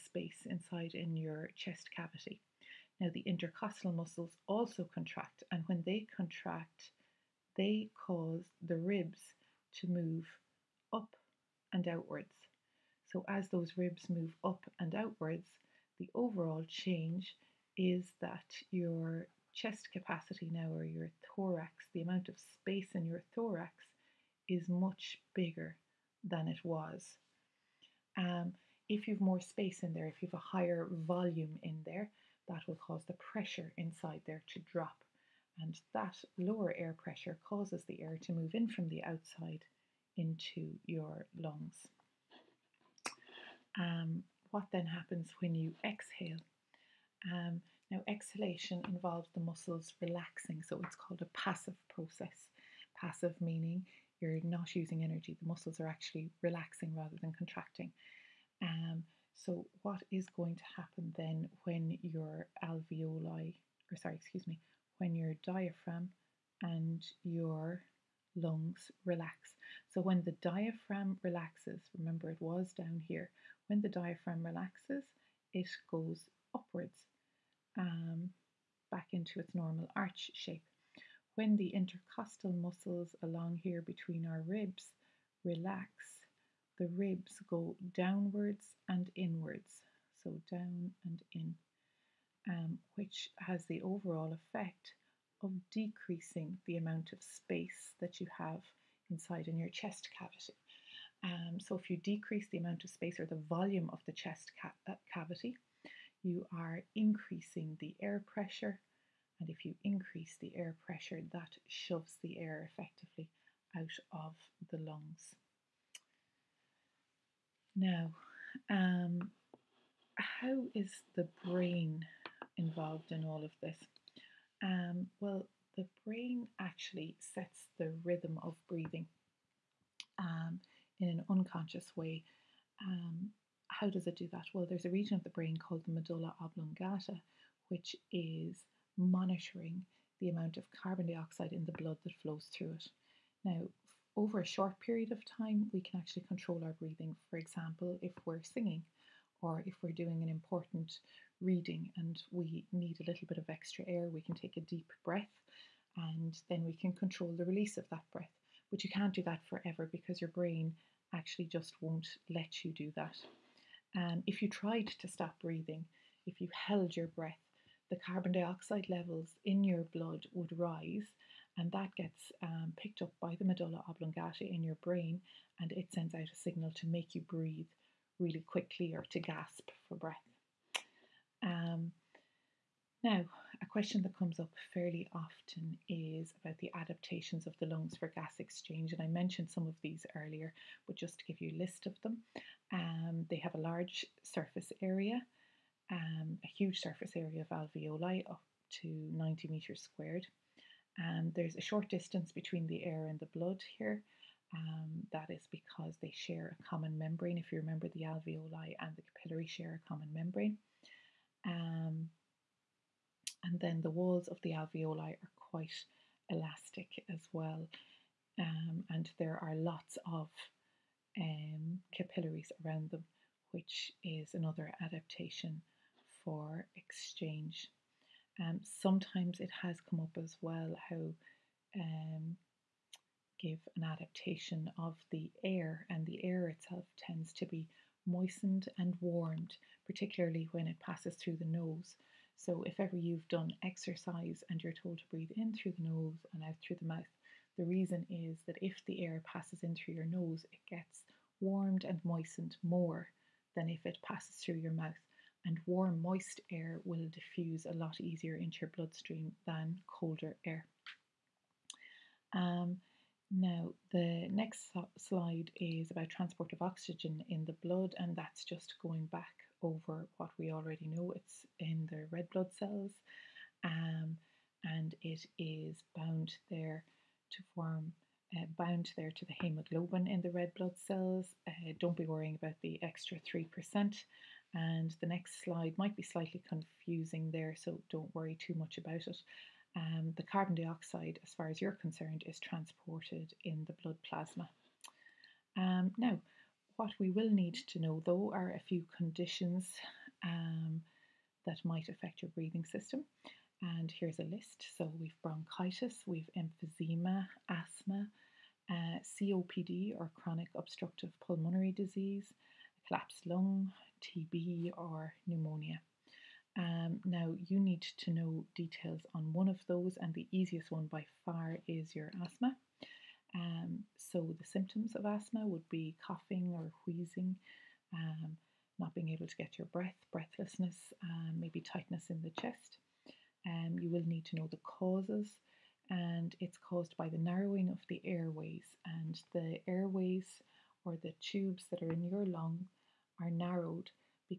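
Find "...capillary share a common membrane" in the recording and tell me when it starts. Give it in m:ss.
3:29.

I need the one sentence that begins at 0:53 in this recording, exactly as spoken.
Passive meaning you're not using energy.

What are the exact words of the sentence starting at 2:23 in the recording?
Now, over a short period of time, we can actually control our breathing.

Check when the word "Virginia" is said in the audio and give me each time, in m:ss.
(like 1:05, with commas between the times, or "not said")
not said.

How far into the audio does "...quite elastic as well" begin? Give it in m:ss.
3:35.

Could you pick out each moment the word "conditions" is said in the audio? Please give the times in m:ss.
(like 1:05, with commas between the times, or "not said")
4:58.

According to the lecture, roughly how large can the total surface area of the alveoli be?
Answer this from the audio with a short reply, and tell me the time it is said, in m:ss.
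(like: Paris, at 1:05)
90 square metres, at 3:19.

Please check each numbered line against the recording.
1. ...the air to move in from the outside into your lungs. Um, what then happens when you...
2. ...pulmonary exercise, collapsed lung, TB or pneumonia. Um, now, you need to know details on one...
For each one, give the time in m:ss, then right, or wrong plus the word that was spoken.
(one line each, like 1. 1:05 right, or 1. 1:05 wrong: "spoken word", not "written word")
1. 0:37 right
2. 5:11 wrong: "disease", not "exercise".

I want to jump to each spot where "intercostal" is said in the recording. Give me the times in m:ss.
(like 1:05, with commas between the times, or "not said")
0:03, 1:21.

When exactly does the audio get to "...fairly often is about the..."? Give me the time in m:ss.
3:04.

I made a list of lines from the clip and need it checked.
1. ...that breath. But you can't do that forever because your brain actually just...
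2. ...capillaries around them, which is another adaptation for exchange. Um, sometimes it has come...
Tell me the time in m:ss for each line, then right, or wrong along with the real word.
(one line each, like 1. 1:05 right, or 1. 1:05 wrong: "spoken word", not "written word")
1. 2:37 right
2. 3:41 right.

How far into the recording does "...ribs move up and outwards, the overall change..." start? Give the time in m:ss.
0:13.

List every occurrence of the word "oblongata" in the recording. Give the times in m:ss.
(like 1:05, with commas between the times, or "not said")
2:16, 2:53.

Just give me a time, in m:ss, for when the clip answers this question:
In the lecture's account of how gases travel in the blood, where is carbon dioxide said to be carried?
4:53.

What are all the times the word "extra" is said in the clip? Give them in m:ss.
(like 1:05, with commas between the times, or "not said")
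2:33, 4:42.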